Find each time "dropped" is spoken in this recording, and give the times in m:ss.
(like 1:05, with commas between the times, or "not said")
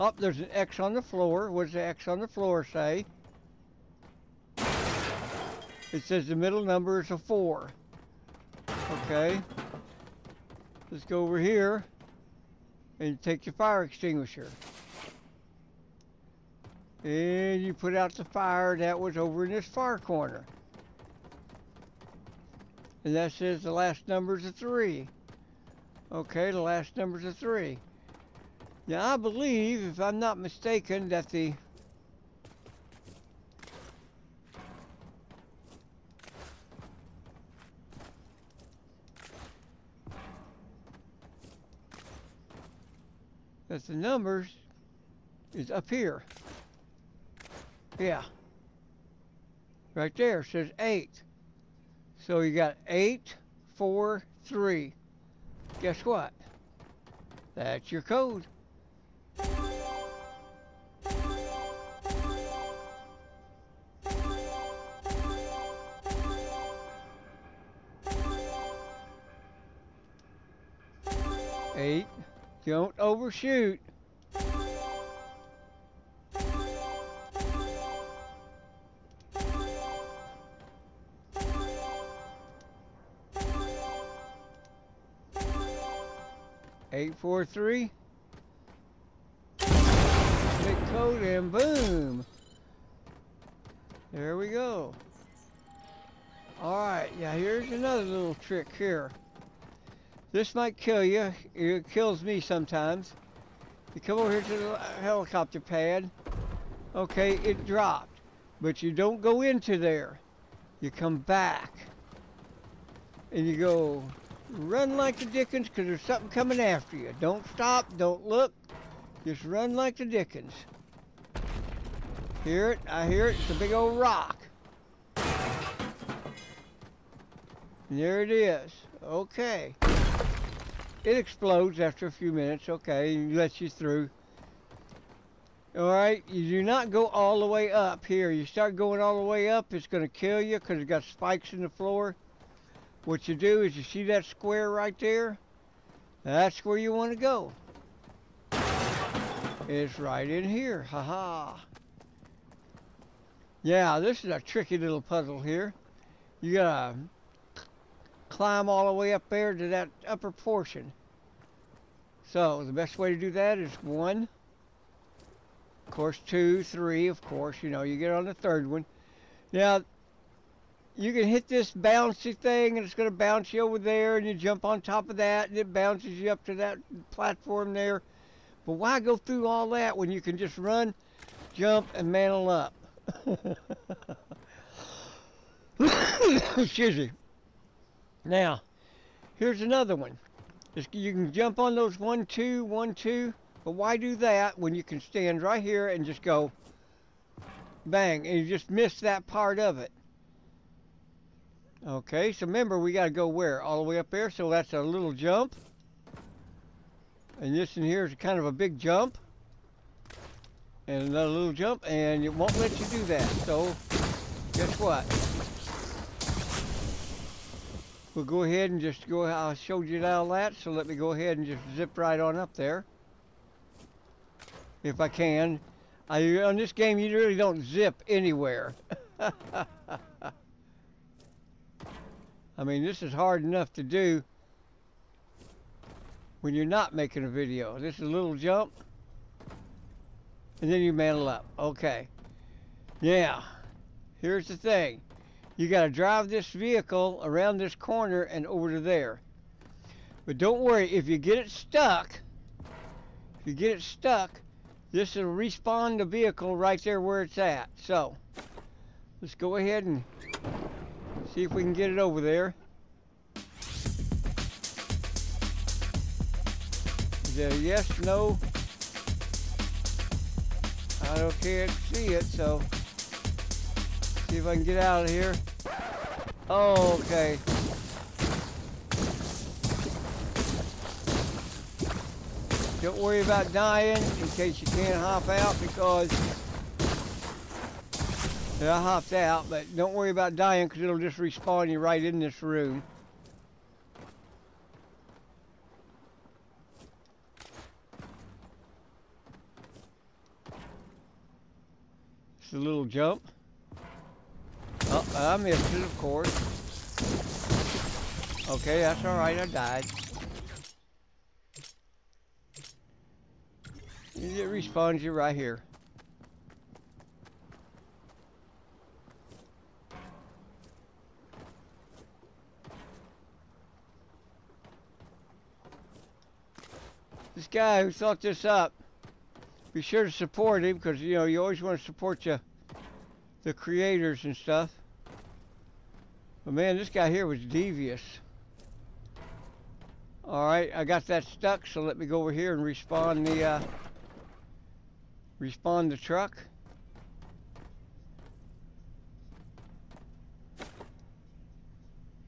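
1:47.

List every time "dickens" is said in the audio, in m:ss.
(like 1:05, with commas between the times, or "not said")
1:55, 2:00.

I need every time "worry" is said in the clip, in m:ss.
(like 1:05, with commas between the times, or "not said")
4:10, 4:42, 4:49.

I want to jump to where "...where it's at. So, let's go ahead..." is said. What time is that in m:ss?
4:17.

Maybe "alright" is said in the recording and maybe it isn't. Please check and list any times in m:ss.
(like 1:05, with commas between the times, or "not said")
1:36, 2:15, 5:09, 5:40.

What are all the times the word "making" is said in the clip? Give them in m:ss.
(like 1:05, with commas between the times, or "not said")
3:56.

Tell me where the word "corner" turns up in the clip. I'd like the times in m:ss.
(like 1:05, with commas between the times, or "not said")
0:19, 4:07.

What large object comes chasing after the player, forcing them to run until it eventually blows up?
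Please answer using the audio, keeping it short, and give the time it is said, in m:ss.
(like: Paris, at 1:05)
a big old rock, at 2:03.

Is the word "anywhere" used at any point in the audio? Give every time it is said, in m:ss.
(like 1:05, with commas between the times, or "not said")
3:48.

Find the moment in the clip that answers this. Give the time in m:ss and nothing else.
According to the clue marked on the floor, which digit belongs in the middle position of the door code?
0:06.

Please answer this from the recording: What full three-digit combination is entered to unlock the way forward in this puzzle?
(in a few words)
843.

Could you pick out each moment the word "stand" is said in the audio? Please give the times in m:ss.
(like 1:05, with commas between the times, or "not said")
3:15.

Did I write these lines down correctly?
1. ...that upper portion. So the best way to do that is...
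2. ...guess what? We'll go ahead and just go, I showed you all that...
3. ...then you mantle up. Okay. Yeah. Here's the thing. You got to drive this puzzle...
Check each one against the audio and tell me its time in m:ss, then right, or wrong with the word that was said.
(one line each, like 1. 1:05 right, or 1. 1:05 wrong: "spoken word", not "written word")
1. 2:39 right
2. 3:34 right
3. 4:00 wrong: "vehicle", not "puzzle".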